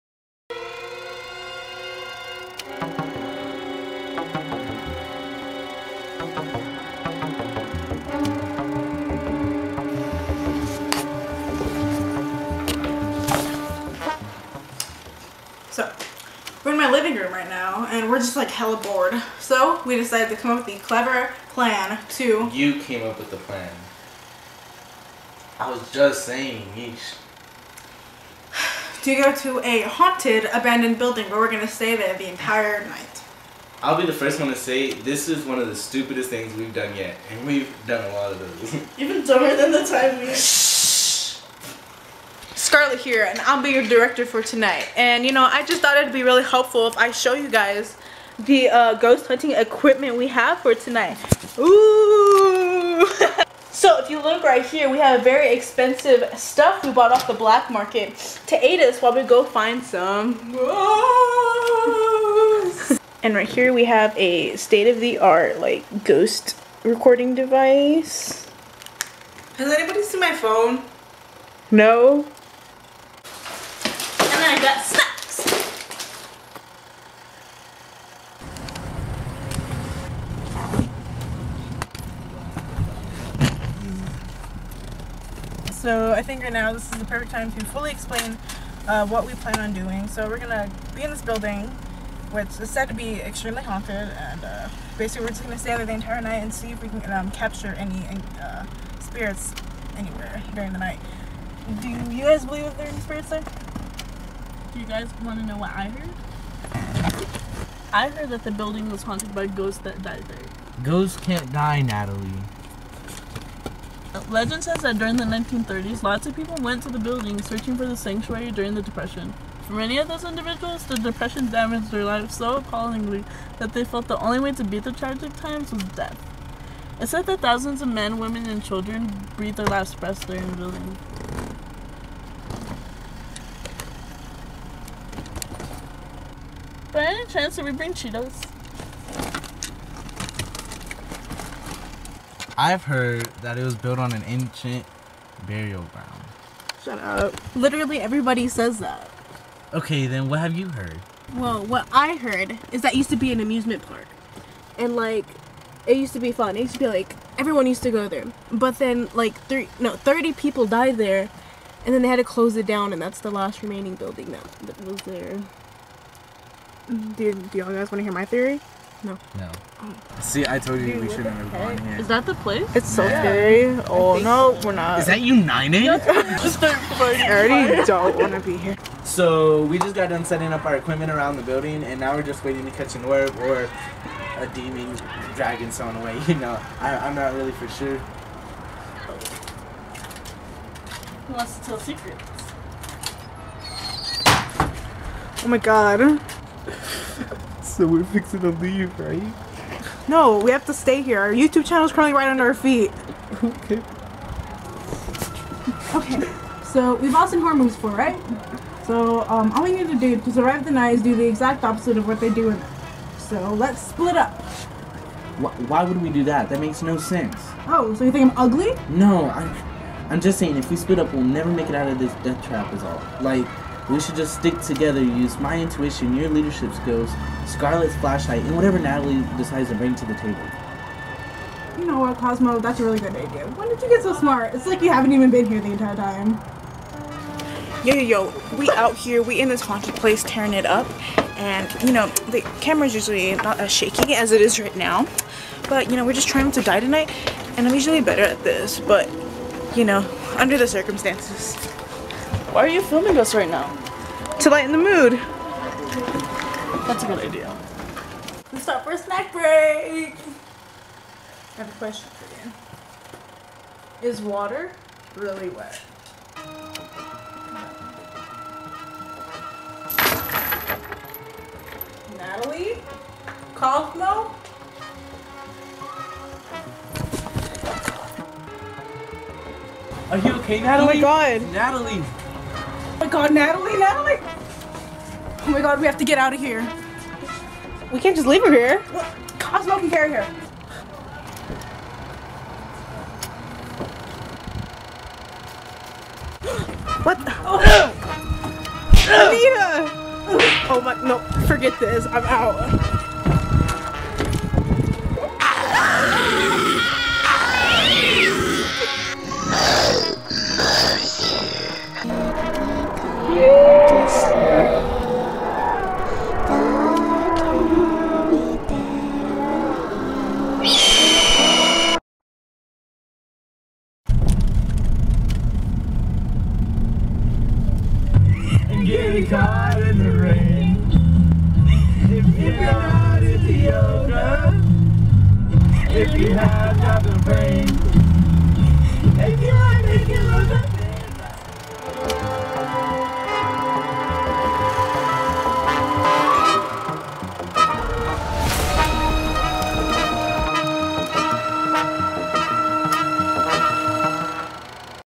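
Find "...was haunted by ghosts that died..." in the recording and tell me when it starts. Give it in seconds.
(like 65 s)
108 s.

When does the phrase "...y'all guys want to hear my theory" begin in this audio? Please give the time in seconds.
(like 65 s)
167 s.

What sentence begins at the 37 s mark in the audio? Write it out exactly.
And we've done a lot of those.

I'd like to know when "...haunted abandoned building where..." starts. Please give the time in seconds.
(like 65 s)
29 s.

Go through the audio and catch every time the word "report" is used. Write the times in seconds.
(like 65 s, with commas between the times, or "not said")
not said.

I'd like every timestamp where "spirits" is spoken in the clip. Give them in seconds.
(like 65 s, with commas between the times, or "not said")
98 s, 102 s.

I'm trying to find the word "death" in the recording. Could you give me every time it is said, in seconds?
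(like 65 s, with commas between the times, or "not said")
125 s, 222 s.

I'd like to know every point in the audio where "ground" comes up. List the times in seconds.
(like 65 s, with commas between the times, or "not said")
145 s.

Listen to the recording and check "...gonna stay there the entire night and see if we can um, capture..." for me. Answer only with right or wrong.
right.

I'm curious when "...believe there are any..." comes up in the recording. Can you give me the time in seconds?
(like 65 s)
102 s.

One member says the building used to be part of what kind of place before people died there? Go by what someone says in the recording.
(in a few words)
an amusement park.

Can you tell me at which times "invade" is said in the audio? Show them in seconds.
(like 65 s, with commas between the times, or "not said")
not said.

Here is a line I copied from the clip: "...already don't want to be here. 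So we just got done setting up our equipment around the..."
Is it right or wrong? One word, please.
right.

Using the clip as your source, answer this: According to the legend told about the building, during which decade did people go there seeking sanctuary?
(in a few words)
1930s.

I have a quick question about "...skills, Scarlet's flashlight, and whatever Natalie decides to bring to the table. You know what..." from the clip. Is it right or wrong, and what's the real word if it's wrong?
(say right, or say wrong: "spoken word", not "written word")
right.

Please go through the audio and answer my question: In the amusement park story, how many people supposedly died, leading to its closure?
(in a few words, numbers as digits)
30.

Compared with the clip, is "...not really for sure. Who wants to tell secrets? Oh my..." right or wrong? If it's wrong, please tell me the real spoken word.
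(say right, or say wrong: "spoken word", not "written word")
right.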